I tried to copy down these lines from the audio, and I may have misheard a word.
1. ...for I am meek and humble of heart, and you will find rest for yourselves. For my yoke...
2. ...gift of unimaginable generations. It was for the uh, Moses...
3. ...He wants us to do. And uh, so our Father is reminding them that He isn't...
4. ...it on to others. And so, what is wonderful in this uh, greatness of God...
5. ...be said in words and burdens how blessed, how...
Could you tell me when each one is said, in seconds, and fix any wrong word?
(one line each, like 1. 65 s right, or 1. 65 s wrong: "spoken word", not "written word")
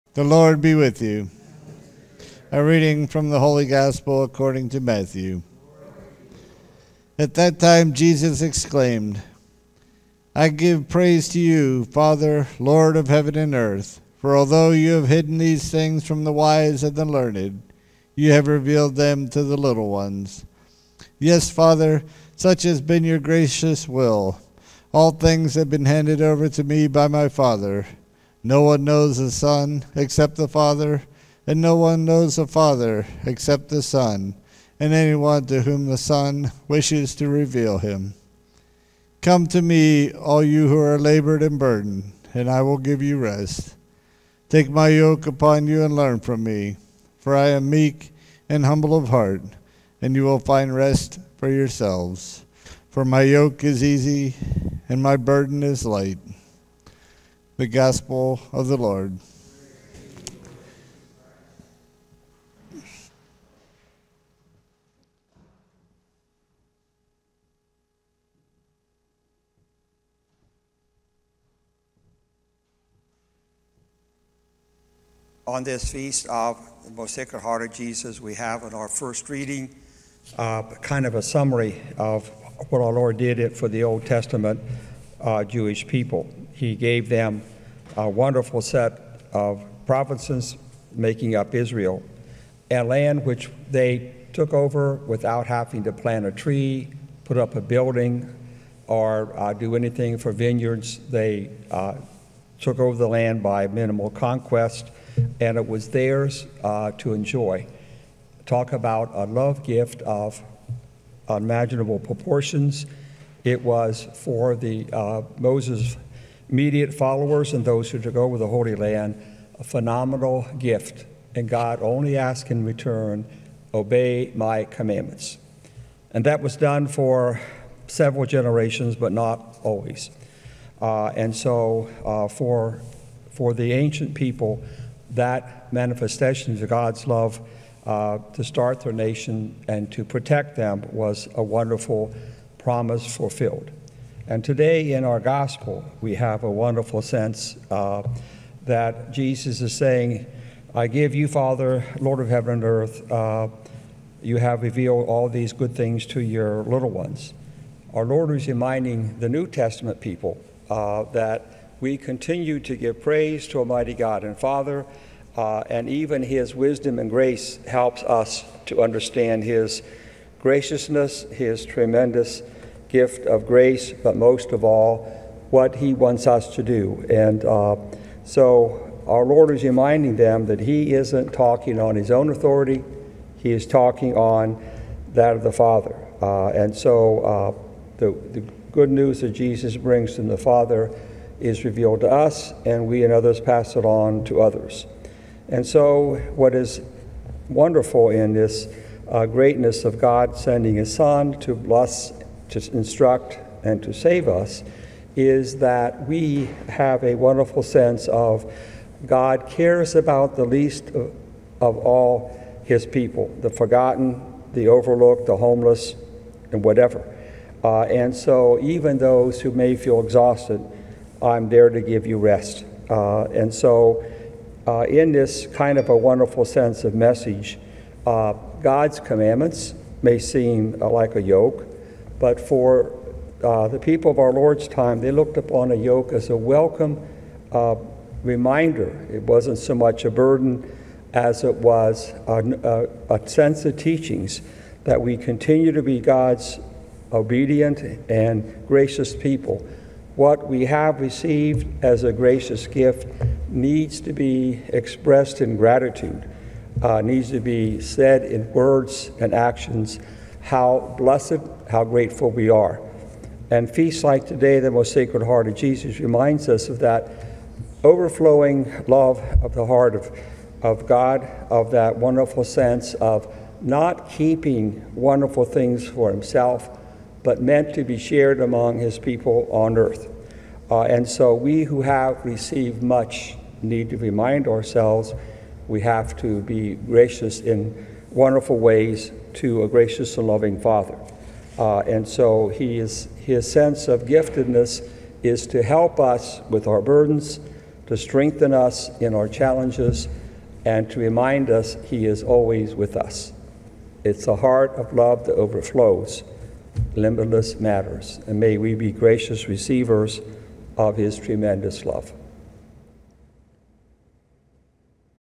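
1. 47 s right
2. 109 s wrong: "proportions", not "generations"
3. 175 s wrong: "Lord", not "Father"
4. 193 s right
5. 257 s wrong: "actions", not "burdens".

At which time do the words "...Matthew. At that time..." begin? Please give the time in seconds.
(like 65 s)
4 s.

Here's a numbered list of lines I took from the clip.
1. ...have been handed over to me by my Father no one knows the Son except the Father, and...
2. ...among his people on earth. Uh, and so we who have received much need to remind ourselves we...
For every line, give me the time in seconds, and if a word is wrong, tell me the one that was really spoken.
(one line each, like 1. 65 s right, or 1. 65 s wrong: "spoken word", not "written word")
1. 25 s right
2. 278 s right.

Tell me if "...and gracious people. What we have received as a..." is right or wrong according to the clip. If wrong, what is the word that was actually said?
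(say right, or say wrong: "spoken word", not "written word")
right.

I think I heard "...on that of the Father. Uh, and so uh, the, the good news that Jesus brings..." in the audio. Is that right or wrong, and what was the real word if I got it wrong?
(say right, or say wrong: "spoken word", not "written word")
right.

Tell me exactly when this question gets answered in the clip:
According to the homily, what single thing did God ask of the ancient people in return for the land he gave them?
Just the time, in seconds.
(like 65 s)
123 s.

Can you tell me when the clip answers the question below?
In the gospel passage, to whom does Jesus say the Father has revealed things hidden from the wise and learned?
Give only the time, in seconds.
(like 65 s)
19 s.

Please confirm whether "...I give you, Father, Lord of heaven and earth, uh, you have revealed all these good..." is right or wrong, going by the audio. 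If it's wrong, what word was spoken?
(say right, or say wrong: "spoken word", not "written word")
right.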